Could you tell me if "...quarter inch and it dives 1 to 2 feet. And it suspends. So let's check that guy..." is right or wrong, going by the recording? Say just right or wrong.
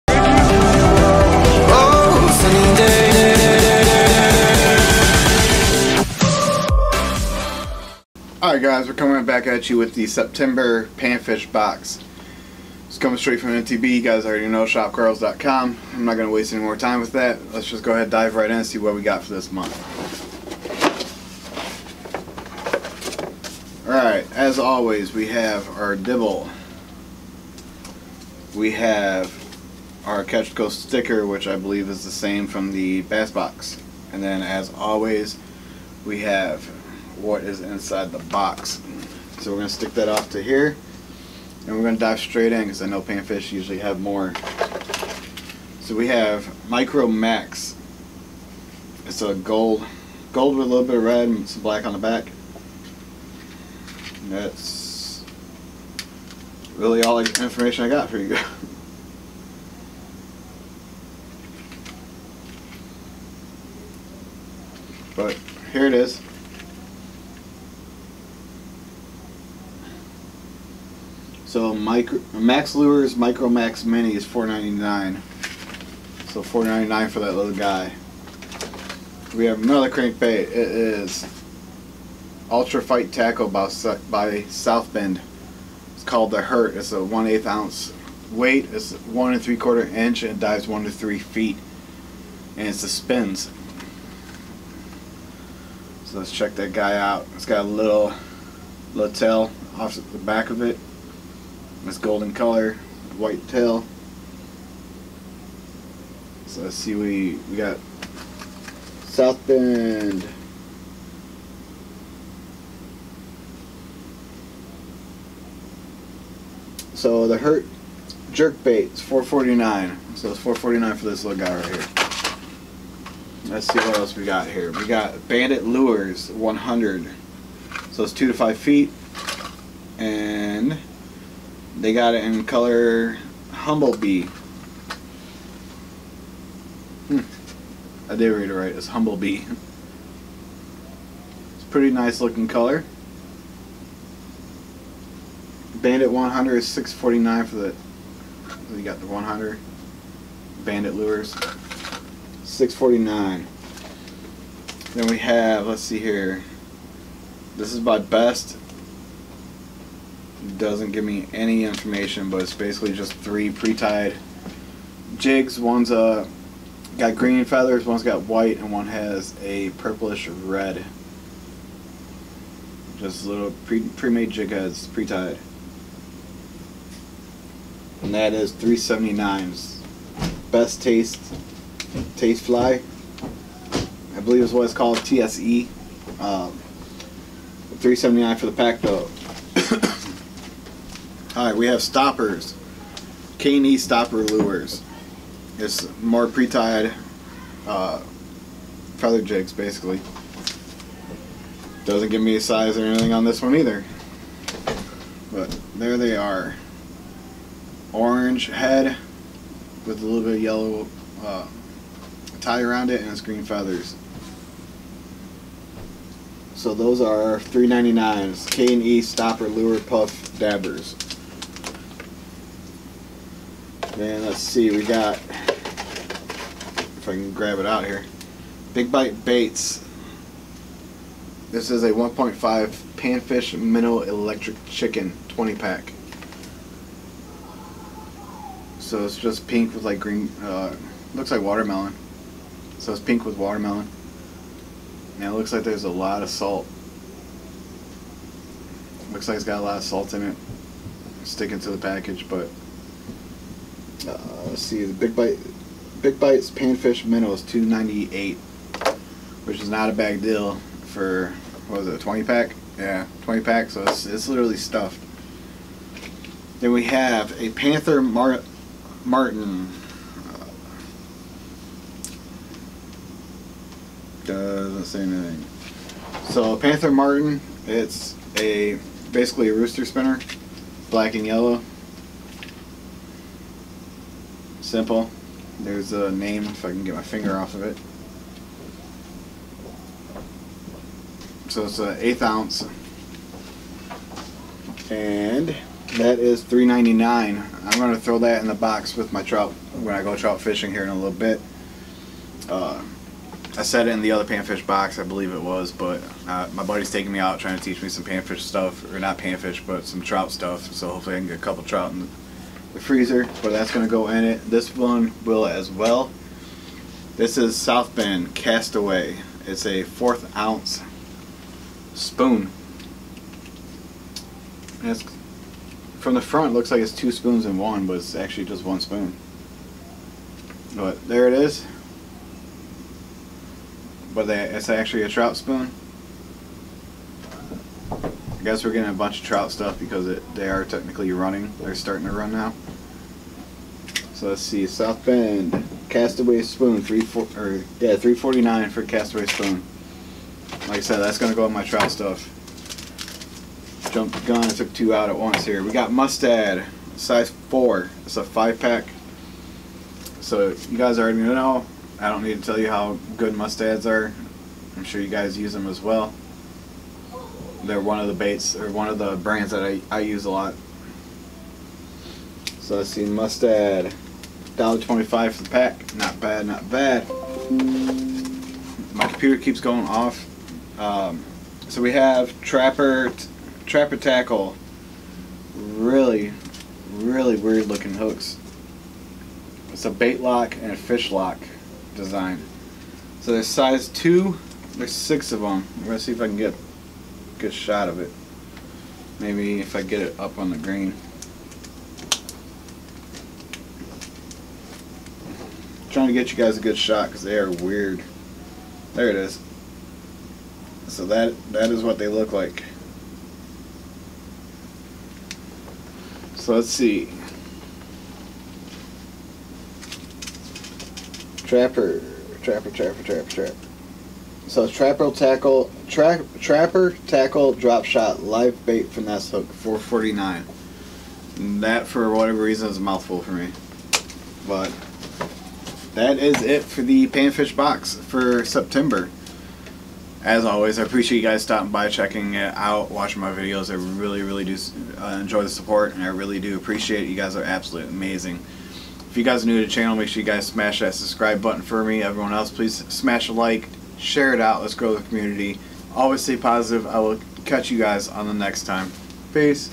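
wrong.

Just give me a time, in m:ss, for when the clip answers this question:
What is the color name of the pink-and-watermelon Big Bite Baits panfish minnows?
3:54.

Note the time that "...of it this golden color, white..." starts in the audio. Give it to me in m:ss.
1:40.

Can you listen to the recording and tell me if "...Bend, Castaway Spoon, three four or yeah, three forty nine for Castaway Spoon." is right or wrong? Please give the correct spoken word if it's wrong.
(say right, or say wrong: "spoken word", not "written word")
right.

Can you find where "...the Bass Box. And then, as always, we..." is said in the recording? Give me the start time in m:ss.
0:32.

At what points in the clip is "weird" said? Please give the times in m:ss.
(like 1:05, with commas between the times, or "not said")
6:27, 6:47.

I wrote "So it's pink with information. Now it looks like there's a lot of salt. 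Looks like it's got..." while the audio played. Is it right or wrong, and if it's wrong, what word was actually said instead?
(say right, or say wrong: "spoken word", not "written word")
wrong: "watermelon", not "information".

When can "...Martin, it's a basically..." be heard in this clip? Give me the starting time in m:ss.
4:36.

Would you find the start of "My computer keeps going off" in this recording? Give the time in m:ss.
6:18.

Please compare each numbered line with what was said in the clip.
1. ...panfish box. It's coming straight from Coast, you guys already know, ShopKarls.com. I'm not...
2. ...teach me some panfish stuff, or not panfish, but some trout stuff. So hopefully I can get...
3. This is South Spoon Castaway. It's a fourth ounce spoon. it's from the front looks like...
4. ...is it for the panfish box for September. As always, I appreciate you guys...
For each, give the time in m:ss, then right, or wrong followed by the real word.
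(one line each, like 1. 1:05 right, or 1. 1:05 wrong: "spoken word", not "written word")
1. 0:10 wrong: "MTB", not "Coast"
2. 5:07 right
3. 5:17 wrong: "Bend", not "Spoon"
4. 7:16 right.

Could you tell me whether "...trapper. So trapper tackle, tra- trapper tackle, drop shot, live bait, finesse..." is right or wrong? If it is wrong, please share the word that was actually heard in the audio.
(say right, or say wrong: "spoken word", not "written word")
right.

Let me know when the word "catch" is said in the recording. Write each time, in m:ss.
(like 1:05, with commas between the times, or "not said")
0:30, 7:37.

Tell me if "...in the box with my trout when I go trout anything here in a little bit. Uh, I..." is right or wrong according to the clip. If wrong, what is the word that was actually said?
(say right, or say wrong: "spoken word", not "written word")
wrong: "fishing", not "anything".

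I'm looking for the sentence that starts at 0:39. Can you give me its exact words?
So we're going to stick that off to here.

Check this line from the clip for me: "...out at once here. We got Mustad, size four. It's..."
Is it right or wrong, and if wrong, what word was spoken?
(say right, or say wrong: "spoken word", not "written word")
right.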